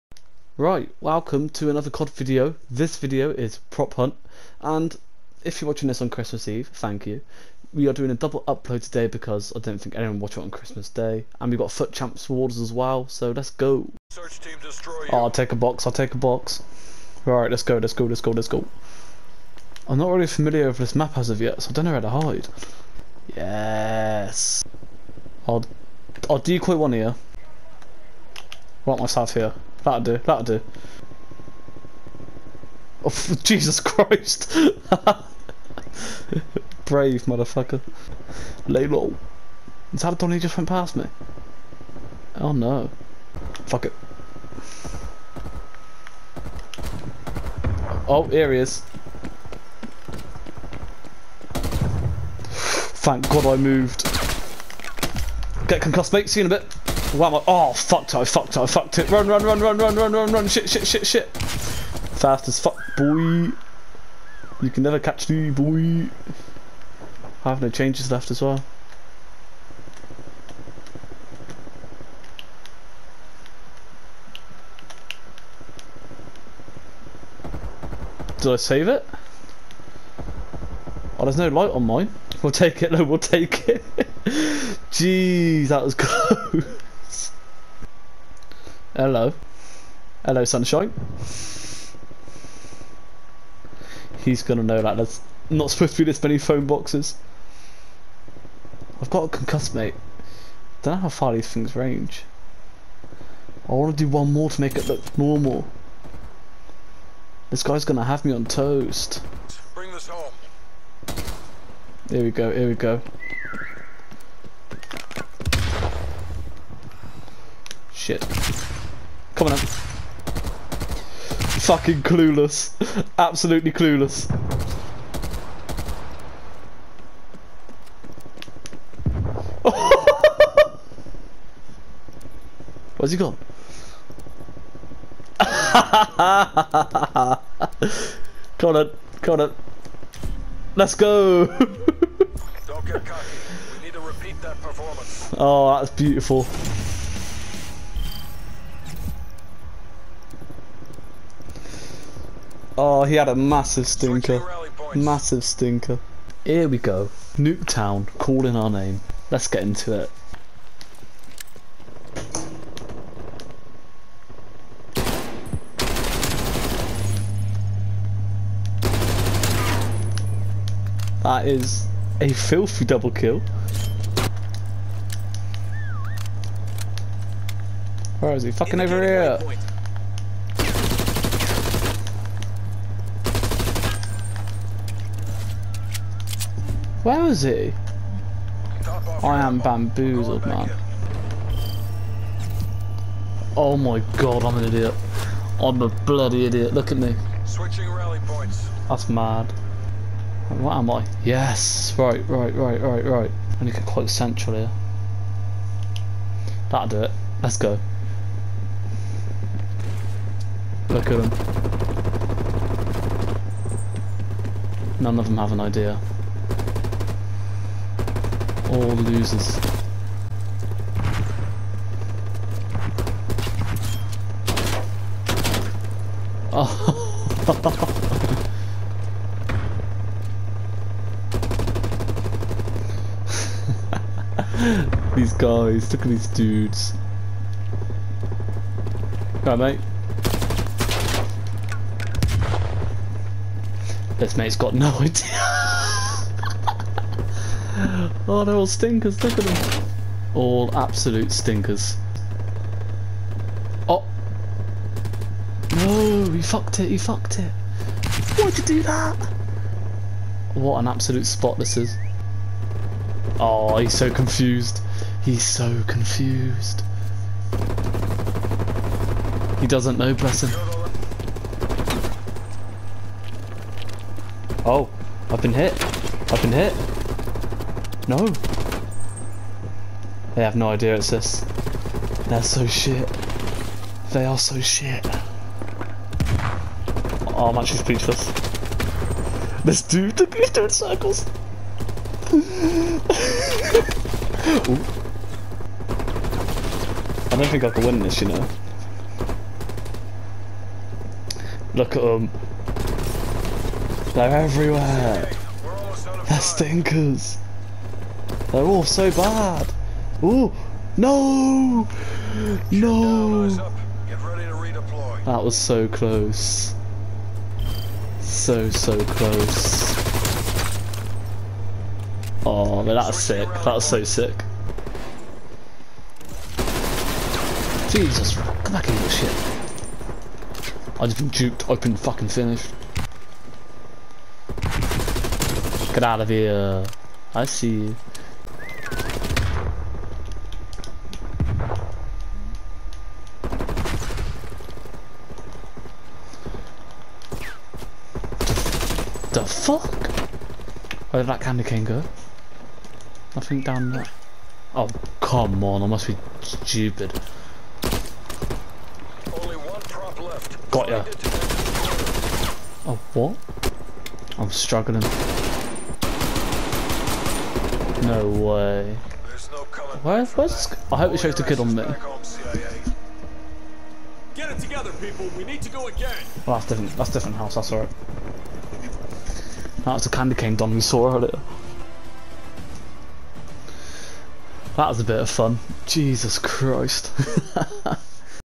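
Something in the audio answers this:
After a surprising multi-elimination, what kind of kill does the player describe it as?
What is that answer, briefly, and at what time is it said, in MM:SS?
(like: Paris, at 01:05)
Double kill, at 02:52.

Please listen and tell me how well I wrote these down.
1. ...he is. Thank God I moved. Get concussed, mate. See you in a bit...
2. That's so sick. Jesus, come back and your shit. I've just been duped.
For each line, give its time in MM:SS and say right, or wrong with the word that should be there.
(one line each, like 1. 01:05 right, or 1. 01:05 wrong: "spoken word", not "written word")
1. 00:48 right
2. 05:23 right.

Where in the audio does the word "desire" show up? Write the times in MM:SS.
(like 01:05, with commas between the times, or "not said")
not said.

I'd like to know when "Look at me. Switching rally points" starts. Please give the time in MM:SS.
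03:16.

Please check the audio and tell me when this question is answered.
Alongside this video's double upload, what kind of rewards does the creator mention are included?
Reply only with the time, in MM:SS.
00:11.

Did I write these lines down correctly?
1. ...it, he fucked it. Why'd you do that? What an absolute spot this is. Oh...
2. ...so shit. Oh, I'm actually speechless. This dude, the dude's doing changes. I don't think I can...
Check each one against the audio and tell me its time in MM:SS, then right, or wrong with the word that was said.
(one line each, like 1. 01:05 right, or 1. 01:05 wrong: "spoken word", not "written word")
1. 04:16 right
2. 04:44 wrong: "circles", not "changes".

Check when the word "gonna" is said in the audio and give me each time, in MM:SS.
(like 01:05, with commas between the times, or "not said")
01:34, 01:47.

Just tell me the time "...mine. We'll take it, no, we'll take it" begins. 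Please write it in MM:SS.
01:21.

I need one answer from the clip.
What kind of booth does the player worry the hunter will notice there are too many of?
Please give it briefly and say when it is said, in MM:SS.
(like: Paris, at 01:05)
Phone boxes, at 01:36.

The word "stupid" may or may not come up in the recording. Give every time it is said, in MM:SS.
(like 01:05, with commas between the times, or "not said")
05:56.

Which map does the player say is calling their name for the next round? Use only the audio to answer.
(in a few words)
Nuketown.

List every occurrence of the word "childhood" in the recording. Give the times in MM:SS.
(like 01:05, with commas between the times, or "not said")
not said.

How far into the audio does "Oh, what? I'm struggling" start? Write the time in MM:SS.
06:02.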